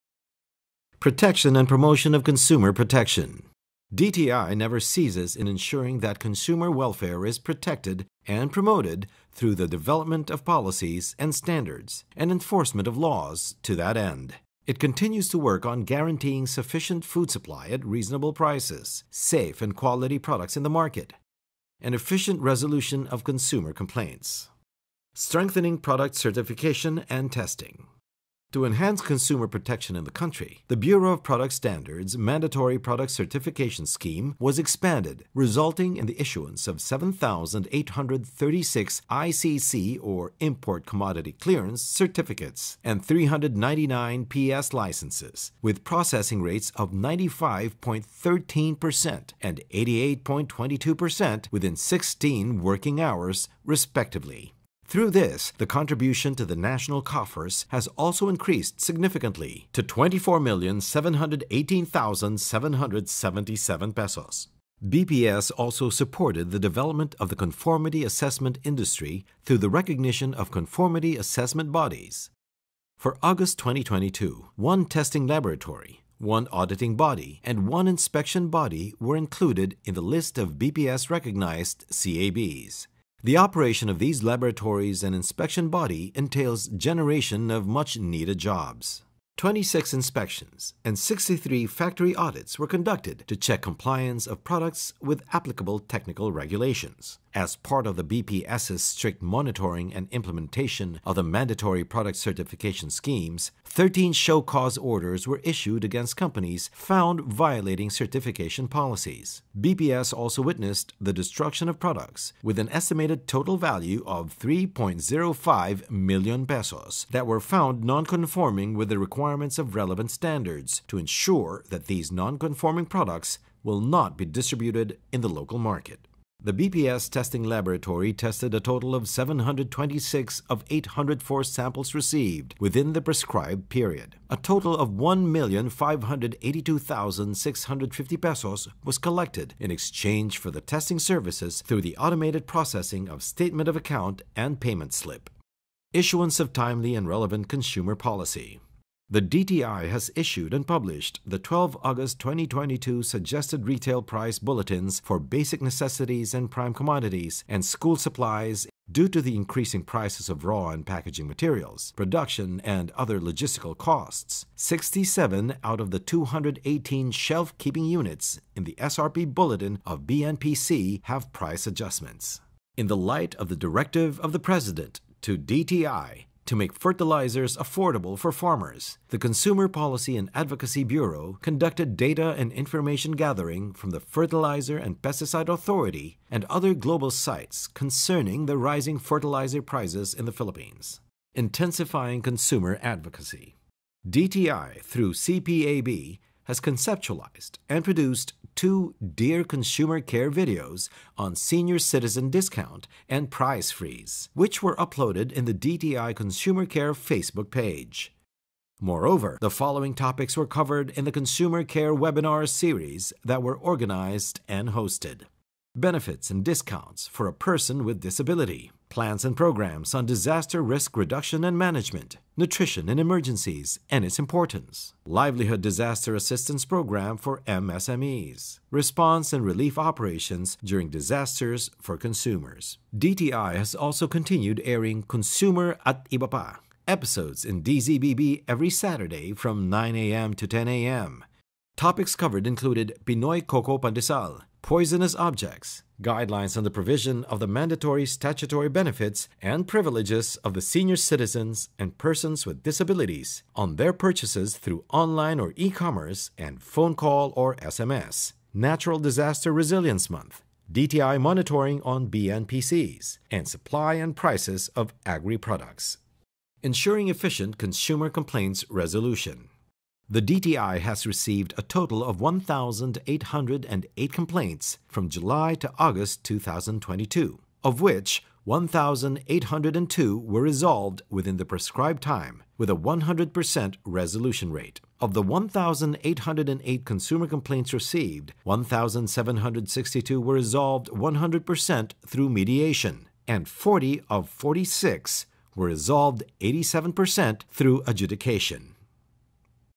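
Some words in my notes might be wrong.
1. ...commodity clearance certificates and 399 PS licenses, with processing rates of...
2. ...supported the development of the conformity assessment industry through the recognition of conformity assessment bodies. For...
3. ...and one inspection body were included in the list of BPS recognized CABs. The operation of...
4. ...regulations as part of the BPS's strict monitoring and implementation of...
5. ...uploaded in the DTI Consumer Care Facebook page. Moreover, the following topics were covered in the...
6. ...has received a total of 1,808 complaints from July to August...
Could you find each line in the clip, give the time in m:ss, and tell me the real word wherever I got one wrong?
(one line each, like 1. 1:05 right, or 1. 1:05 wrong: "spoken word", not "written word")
1. 0:40 right
2. 1:05 right
3. 1:17 right
4. 1:36 right
5. 3:24 right
6. 4:30 right.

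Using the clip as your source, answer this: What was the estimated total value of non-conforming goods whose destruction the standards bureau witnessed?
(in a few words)
3.05 million pesos.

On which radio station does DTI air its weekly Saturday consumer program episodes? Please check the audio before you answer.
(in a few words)
DZBB.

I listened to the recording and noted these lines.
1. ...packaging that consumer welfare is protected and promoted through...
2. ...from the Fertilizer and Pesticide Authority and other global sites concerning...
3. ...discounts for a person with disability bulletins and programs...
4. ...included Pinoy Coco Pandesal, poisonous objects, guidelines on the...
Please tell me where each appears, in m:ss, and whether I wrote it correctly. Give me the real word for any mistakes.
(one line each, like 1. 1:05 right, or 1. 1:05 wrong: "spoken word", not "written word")
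1. 0:05 wrong: "ensuring", not "packaging"
2. 3:03 right
3. 3:36 wrong: "plans", not "bulletins"
4. 4:02 right.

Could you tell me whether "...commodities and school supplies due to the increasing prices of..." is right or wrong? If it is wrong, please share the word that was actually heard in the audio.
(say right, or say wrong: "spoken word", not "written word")
right.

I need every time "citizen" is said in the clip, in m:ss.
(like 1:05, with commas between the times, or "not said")
3:21, 4:10.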